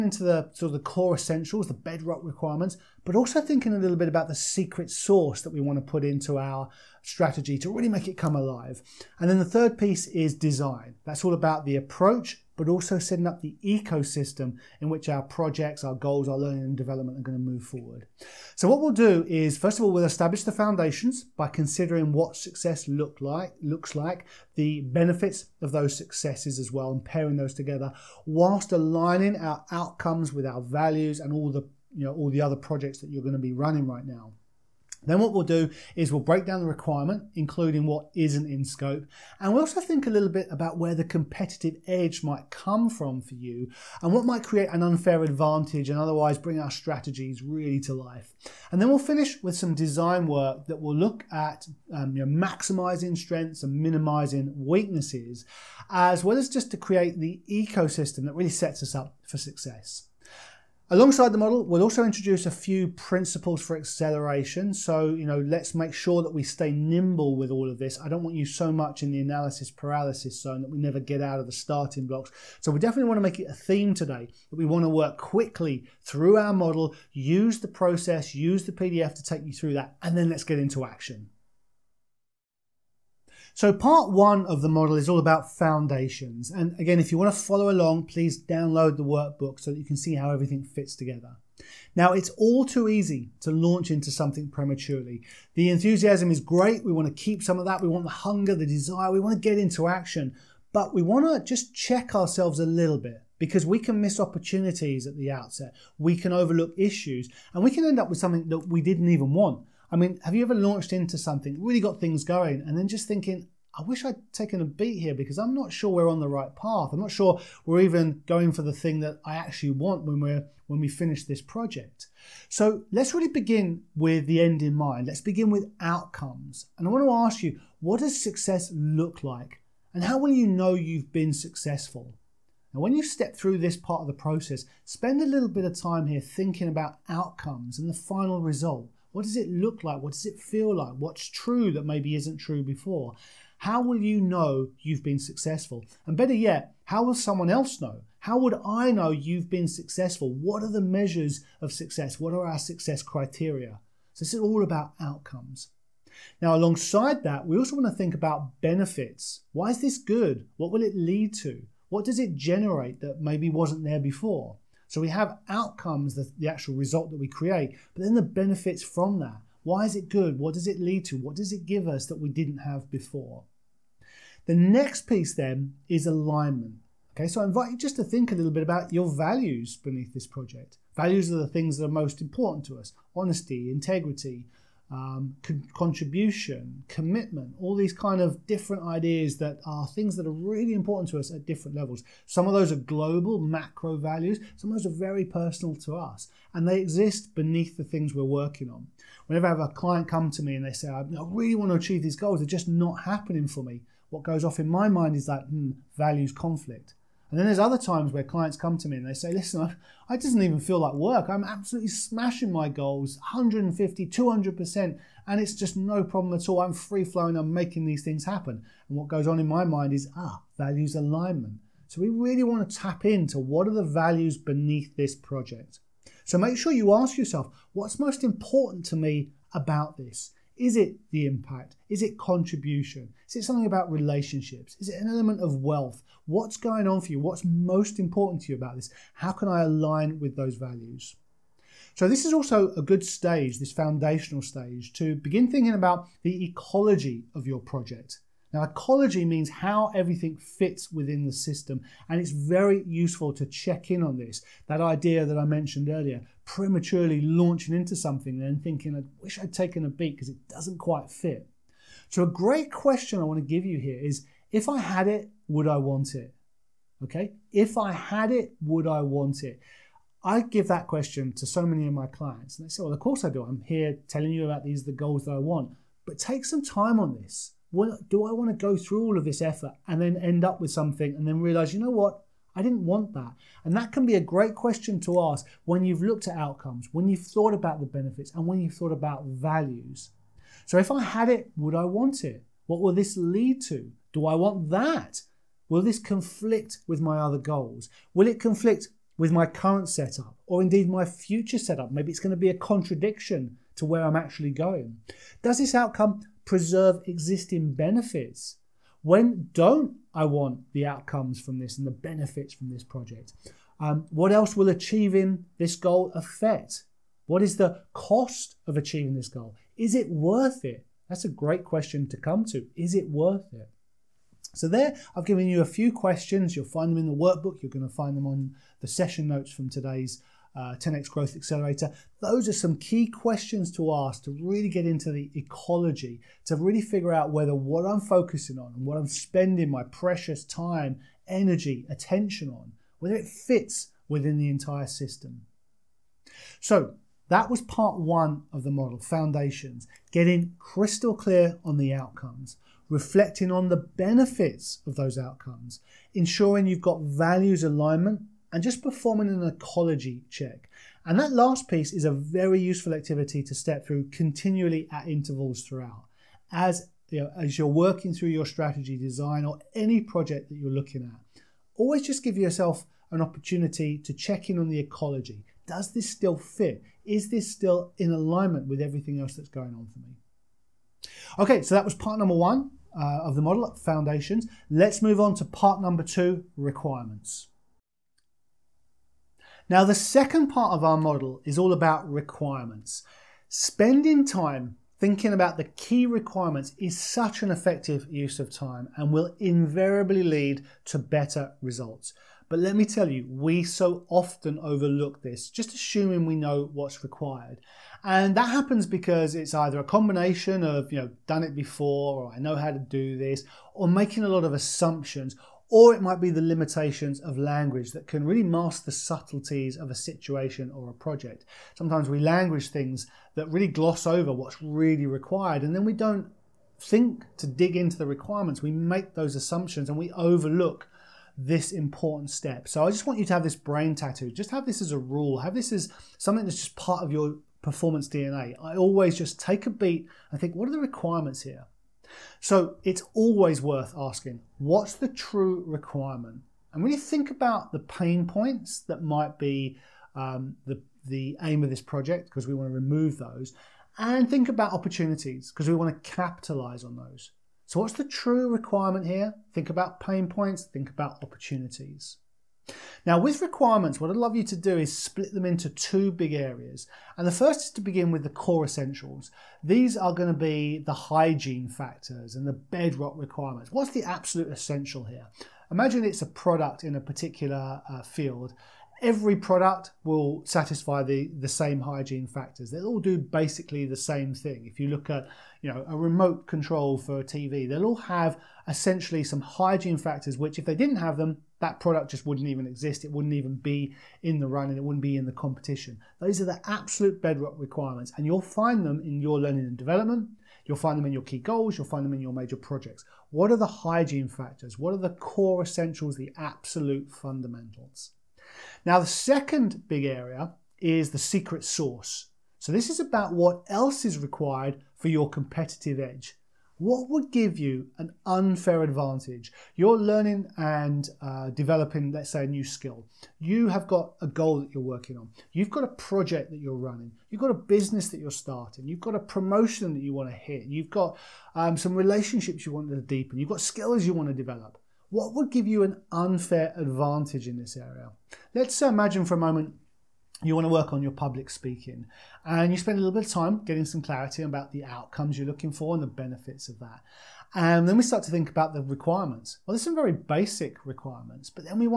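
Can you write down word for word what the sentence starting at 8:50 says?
You've got um, some relationships you want to deepen.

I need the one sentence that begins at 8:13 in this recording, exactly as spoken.
It wouldn't even be in the run and it wouldn't be in the competition.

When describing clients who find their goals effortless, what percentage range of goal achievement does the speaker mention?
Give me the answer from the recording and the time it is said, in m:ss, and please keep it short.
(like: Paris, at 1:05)
150, 200%, at 3:33.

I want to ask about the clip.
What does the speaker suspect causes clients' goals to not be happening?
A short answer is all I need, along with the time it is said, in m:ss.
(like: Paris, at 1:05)
Values conflict, at 3:25.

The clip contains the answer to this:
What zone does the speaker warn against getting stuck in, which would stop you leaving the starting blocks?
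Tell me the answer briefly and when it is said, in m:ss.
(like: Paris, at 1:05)
Analysis paralysis, at 1:09.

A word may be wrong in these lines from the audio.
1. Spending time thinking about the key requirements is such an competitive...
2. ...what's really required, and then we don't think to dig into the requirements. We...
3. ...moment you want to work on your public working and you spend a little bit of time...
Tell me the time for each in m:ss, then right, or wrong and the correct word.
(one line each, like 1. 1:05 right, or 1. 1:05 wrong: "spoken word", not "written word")
1. 6:33 wrong: "effective", not "competitive"
2. 7:04 right
3. 8:59 wrong: "speaking", not "working".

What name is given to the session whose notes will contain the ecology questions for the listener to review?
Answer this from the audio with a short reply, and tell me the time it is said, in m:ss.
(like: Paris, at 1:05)
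10x Growth Accelerator, at 5:30.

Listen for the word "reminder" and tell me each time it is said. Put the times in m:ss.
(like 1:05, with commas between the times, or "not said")
not said.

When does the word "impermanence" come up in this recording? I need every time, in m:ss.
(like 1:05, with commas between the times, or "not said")
not said.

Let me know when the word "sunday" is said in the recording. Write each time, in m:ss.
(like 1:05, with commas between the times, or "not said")
not said.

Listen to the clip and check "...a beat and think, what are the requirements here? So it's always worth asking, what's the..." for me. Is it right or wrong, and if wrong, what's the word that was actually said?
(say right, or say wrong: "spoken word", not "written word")
right.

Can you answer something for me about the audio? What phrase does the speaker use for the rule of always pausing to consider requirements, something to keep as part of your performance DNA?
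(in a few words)
Brain tattoo.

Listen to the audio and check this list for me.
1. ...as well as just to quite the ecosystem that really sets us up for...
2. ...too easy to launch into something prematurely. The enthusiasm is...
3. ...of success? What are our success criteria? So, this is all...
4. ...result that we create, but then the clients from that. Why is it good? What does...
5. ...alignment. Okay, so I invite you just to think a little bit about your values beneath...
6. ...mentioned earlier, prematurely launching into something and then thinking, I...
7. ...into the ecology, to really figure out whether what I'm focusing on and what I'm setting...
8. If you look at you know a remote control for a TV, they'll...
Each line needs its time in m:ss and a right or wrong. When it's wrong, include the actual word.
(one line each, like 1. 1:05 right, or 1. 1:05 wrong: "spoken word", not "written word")
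1. 0:55 wrong: "create", not "quite"
2. 1:32 right
3. 2:31 right
4. 2:46 wrong: "benefits", not "clients"
5. 2:56 right
6. 4:15 right
7. 5:34 wrong: "spending", not "setting"
8. 8:04 right.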